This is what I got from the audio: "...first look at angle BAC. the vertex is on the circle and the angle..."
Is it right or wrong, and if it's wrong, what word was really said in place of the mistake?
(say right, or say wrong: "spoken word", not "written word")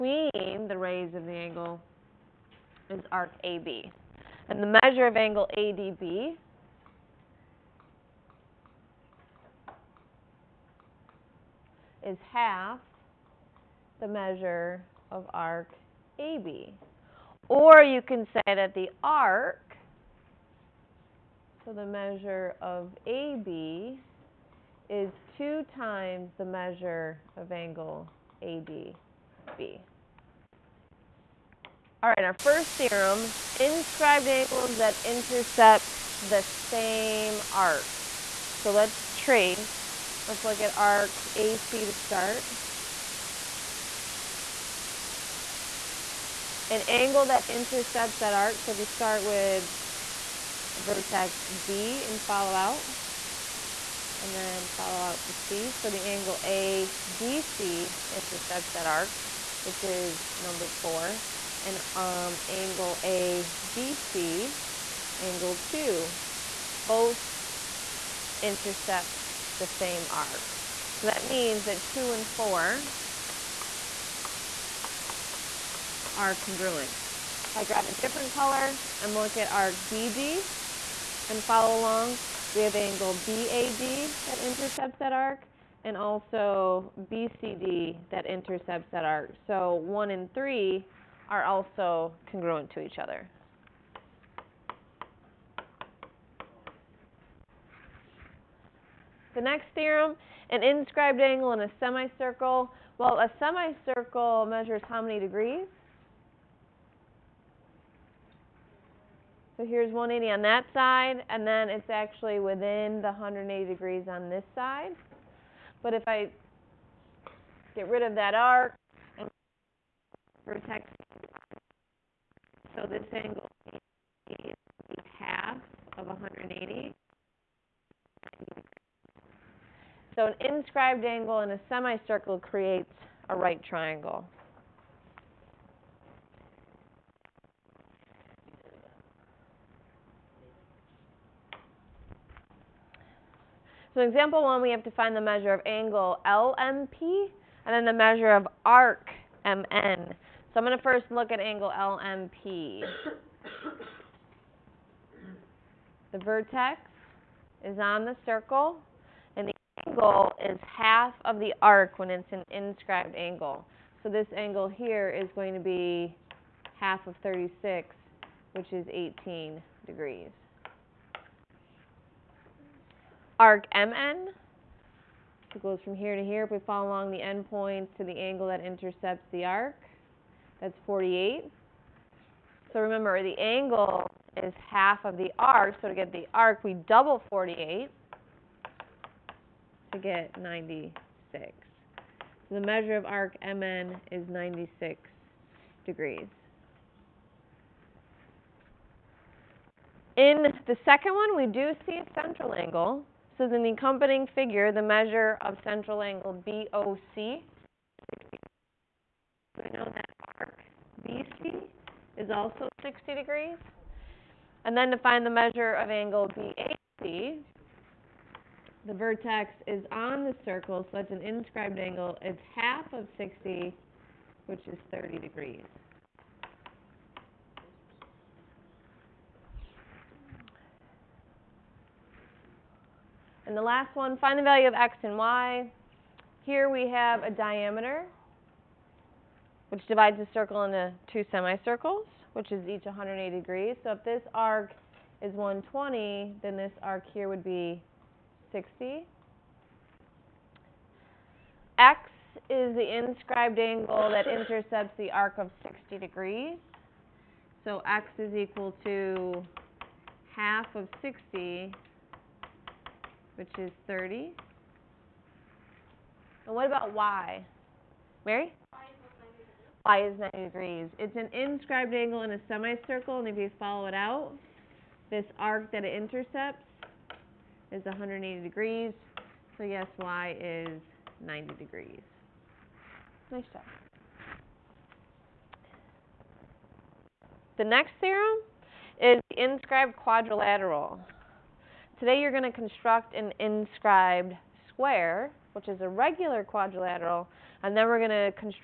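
wrong: "LMP", not "BAC".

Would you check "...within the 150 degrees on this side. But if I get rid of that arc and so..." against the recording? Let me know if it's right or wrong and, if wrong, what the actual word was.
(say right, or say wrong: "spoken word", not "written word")
wrong: "180", not "150".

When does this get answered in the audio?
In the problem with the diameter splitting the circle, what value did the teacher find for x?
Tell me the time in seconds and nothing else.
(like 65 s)
257 s.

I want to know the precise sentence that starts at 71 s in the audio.
So that means that 2 and 4 are congruent.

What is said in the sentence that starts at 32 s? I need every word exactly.
All right, our first theorem, inscribed angles that intercept the same arc.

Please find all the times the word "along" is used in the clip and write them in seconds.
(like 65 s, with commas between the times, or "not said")
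81 s, 176 s.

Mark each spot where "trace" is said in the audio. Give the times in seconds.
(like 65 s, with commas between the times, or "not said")
39 s.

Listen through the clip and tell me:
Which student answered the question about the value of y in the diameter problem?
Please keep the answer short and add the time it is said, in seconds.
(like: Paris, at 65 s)
Mary, at 268 s.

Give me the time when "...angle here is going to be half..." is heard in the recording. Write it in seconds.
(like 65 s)
164 s.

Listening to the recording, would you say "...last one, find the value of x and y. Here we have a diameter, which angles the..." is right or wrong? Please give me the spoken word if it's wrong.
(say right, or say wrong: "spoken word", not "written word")
wrong: "divides", not "angles".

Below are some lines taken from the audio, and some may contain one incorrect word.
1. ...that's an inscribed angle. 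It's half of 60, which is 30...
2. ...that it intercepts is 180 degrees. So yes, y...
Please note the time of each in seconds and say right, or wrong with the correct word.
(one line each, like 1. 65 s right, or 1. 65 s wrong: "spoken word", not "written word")
1. 220 s right
2. 275 s right.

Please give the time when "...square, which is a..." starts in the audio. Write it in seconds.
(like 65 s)
294 s.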